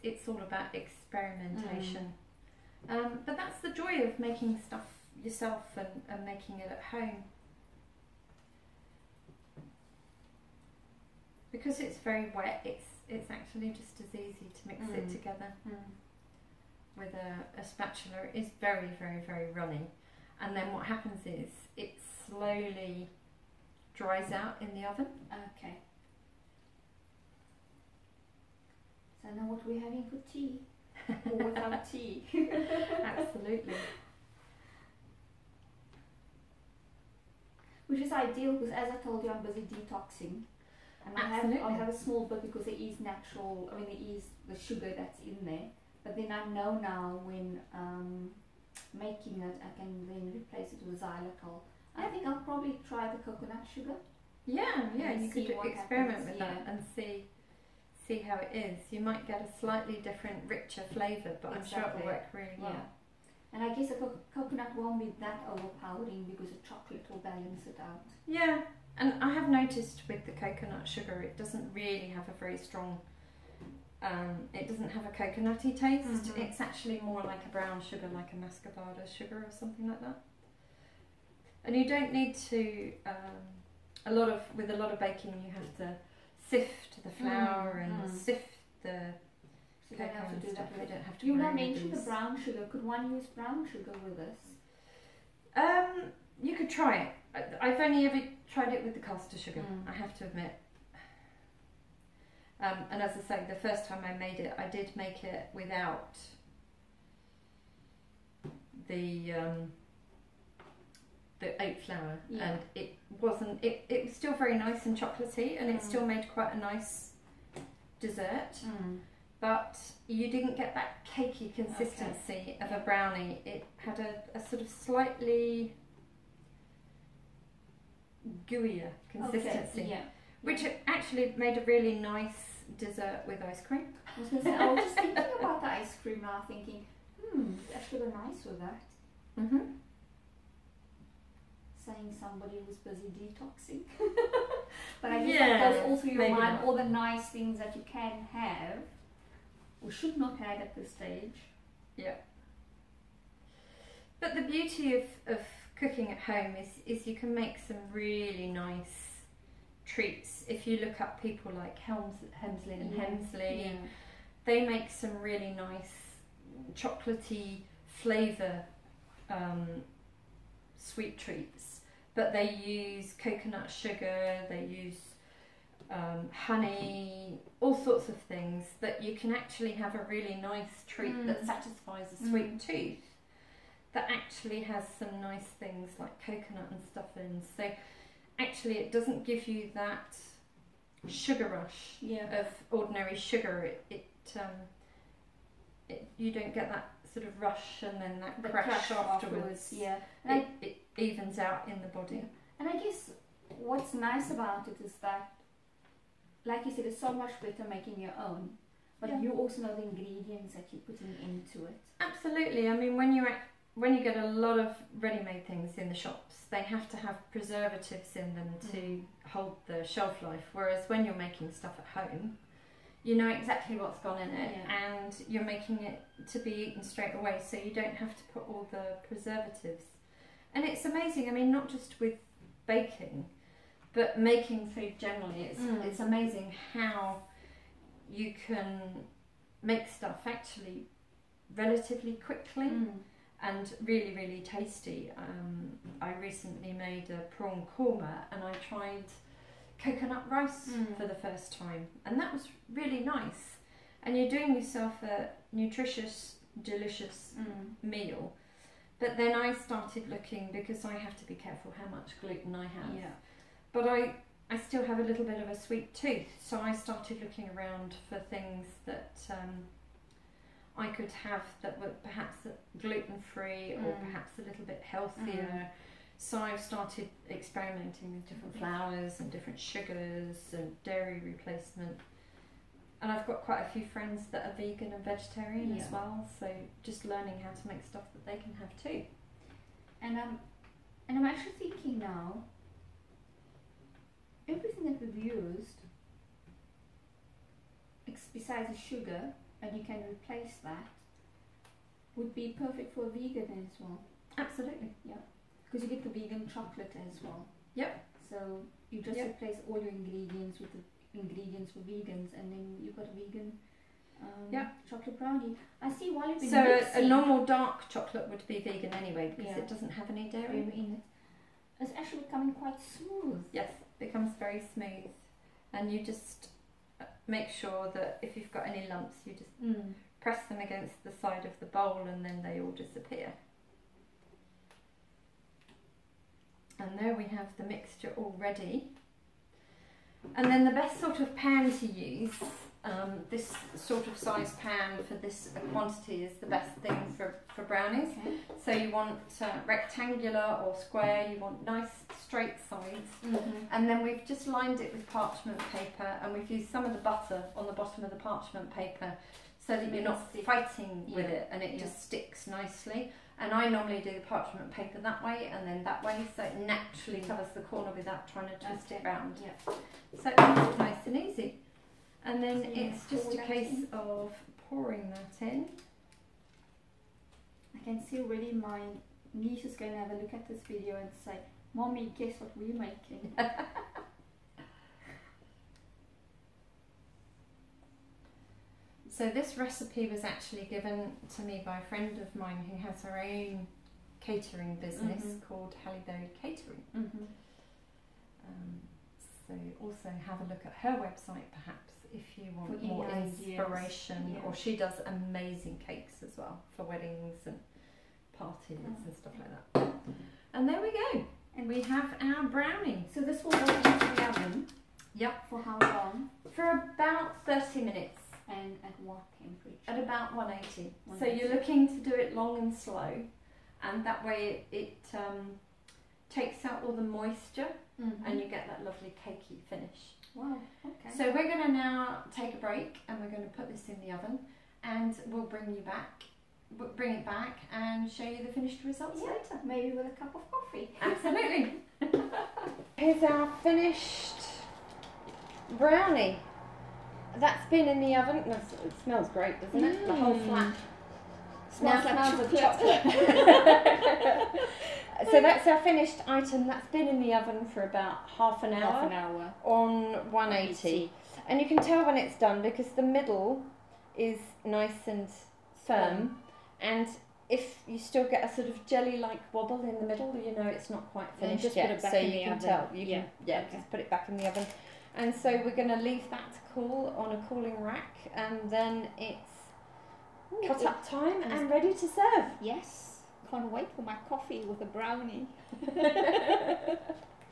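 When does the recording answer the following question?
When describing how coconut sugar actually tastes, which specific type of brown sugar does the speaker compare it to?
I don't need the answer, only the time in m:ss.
1:18.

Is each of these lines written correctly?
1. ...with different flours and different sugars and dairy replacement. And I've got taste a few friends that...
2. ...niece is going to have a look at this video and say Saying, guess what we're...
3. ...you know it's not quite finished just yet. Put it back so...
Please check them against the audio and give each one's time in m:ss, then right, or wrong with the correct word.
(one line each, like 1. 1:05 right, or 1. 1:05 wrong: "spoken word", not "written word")
1. 4:38 wrong: "quite", not "taste"
2. 6:19 wrong: "Mommy", not "Saying"
3. 7:50 right.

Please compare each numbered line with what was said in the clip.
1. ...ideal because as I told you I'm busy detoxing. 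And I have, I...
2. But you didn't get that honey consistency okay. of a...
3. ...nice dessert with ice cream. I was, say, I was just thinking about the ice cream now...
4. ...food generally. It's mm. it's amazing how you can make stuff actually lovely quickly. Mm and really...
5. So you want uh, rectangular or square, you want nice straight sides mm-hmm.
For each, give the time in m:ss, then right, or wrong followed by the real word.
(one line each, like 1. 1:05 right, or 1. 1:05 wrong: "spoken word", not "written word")
1. 0:38 right
2. 1:59 wrong: "cakey", not "honey"
3. 2:11 right
4. 3:54 wrong: "relatively", not "lovely"
5. 5:48 right.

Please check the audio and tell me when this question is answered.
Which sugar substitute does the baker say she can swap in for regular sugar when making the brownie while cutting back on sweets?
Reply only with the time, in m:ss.
0:50.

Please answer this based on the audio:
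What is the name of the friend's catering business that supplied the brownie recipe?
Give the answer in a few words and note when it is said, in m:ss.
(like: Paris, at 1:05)
Halleberry Catering, at 6:35.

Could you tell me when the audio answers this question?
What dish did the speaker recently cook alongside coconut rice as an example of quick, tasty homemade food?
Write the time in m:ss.
4:07.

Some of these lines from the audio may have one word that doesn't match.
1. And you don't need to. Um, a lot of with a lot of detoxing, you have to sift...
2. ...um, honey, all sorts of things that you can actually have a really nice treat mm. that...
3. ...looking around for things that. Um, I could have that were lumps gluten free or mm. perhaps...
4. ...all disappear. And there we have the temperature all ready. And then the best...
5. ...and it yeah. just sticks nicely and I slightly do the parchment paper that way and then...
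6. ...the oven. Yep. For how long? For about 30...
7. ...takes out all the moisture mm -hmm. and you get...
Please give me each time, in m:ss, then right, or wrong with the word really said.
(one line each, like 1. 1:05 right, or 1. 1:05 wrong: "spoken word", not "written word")
1. 1:21 wrong: "baking", not "detoxing"
2. 2:55 right
3. 4:27 wrong: "perhaps", not "lumps"
4. 5:32 wrong: "mixture", not "temperature"
5. 6:01 wrong: "normally", not "slightly"
6. 6:54 right
7. 7:06 right.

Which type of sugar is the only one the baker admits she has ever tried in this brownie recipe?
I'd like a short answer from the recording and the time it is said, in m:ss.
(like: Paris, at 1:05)
caster sugar, at 1:38.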